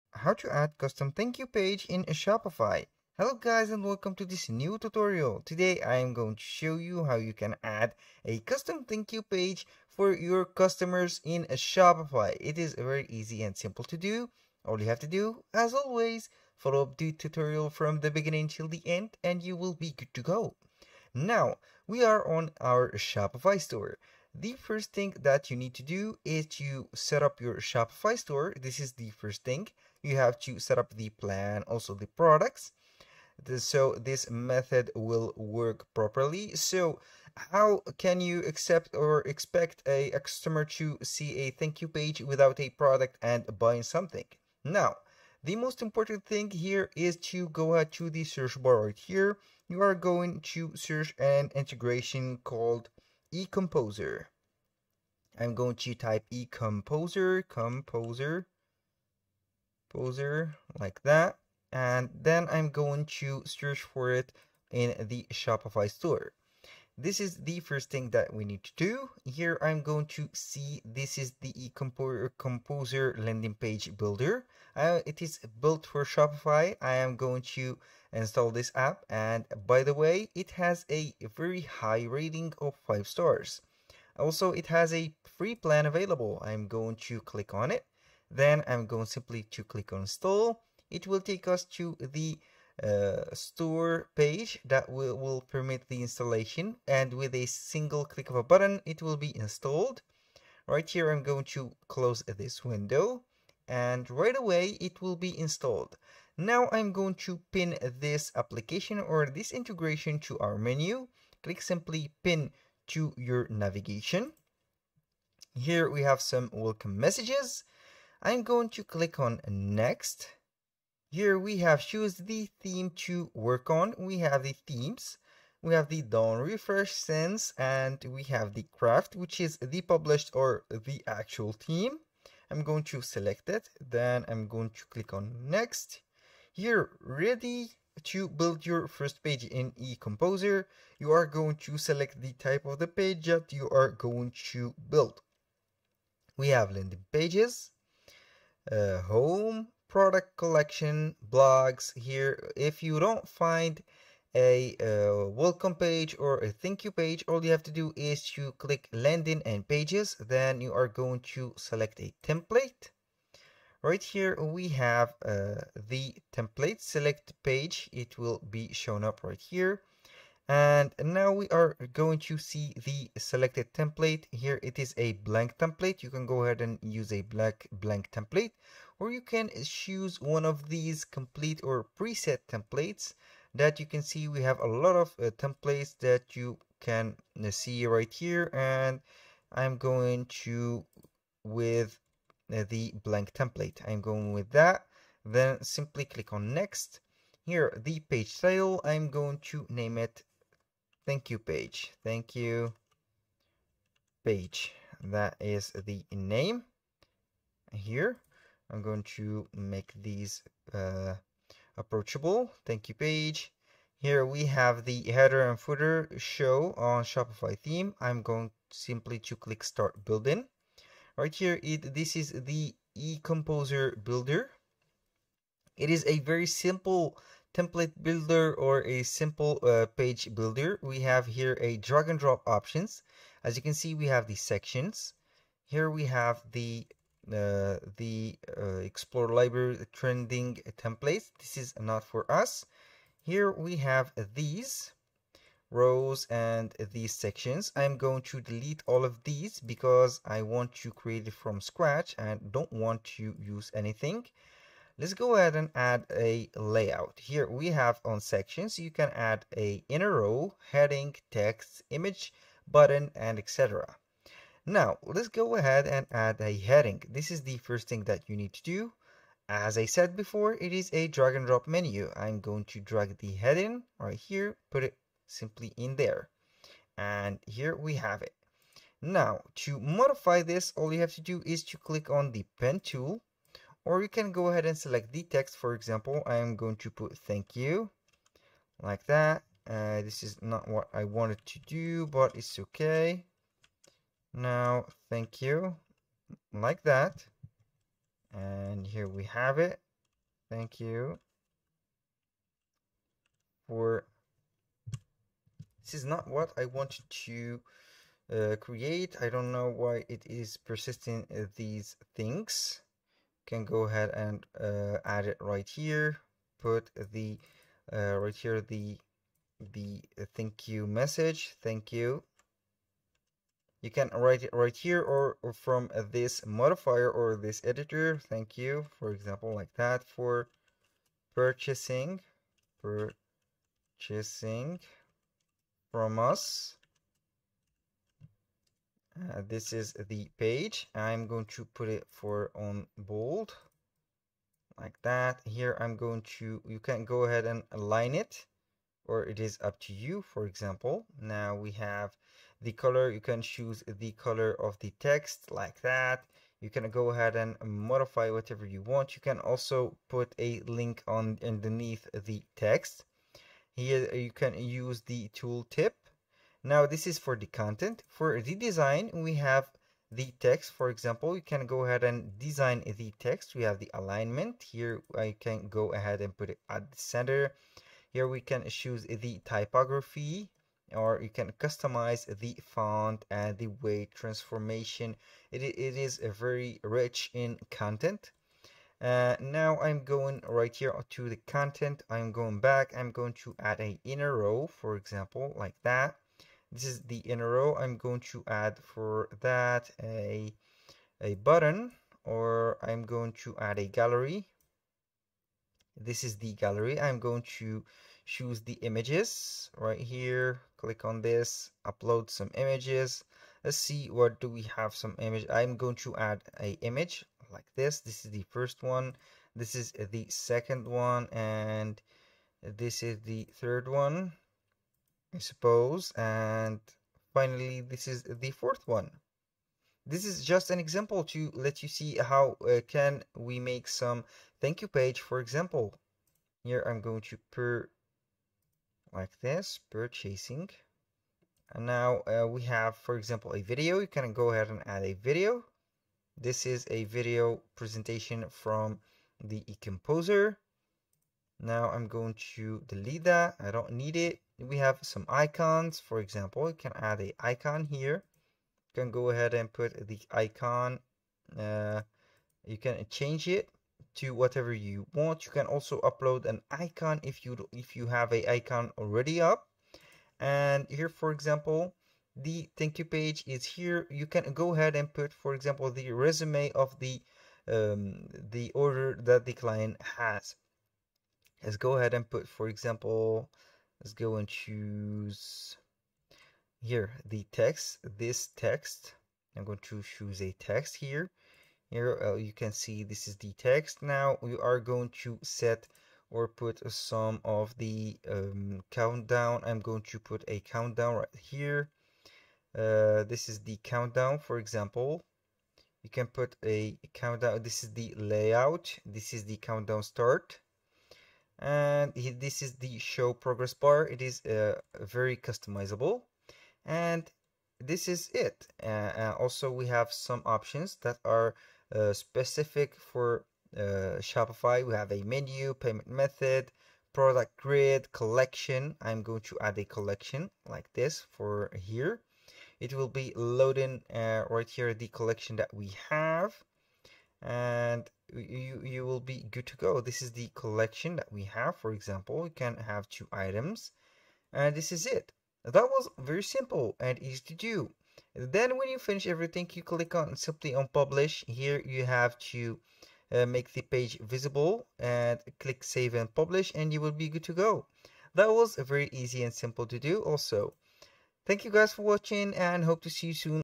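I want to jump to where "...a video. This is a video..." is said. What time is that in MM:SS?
07:25.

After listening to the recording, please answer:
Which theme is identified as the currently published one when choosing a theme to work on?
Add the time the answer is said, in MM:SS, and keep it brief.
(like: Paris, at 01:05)
Craft, at 02:08.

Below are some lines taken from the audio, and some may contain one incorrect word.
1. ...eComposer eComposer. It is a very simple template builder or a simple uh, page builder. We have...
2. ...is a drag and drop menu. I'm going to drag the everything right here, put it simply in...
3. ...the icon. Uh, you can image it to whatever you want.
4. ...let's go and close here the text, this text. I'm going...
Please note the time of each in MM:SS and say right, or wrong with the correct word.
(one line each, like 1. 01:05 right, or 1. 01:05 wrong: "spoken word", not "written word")
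1. 03:42 wrong: "builder", not "eComposer"
2. 04:30 wrong: "heading", not "everything"
3. 07:40 wrong: "change", not "image"
4. 08:04 wrong: "choose", not "close".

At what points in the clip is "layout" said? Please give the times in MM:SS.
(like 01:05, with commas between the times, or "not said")
04:16, 08:28.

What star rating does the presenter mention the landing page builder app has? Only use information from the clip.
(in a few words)
5 stars.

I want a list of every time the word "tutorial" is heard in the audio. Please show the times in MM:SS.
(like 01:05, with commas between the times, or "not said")
00:04, 00:17.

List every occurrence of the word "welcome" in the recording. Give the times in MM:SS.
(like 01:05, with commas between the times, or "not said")
00:03, 01:56, 02:35.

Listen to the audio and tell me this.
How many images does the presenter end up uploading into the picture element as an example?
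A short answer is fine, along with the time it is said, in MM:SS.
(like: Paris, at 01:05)
4, at 07:08.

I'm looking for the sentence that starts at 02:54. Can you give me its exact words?
Here it is a blank template.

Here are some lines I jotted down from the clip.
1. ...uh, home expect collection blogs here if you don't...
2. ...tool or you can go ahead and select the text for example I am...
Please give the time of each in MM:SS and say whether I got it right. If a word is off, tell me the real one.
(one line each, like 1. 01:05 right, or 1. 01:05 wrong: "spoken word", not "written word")
1. 02:28 wrong: "product", not "expect"
2. 04:42 right.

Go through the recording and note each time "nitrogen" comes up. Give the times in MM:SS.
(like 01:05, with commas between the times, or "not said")
not said.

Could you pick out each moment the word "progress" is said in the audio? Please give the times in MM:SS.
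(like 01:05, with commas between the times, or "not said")
08:33.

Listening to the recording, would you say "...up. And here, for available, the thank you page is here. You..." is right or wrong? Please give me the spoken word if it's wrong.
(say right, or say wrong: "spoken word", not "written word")
wrong: "example", not "available".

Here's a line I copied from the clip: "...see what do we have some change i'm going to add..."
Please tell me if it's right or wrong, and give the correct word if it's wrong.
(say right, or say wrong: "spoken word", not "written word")
wrong: "image", not "change".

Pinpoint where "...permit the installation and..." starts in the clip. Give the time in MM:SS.
01:35.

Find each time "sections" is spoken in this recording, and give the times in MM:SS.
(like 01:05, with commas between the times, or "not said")
03:54, 04:07, 04:18.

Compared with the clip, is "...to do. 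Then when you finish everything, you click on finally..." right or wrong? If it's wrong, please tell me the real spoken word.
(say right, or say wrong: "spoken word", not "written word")
wrong: "simply", not "finally".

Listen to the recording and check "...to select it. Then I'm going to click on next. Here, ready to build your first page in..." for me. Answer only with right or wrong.
right.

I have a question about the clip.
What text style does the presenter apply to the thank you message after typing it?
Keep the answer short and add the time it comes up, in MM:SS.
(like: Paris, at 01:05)
Bold, at 05:42.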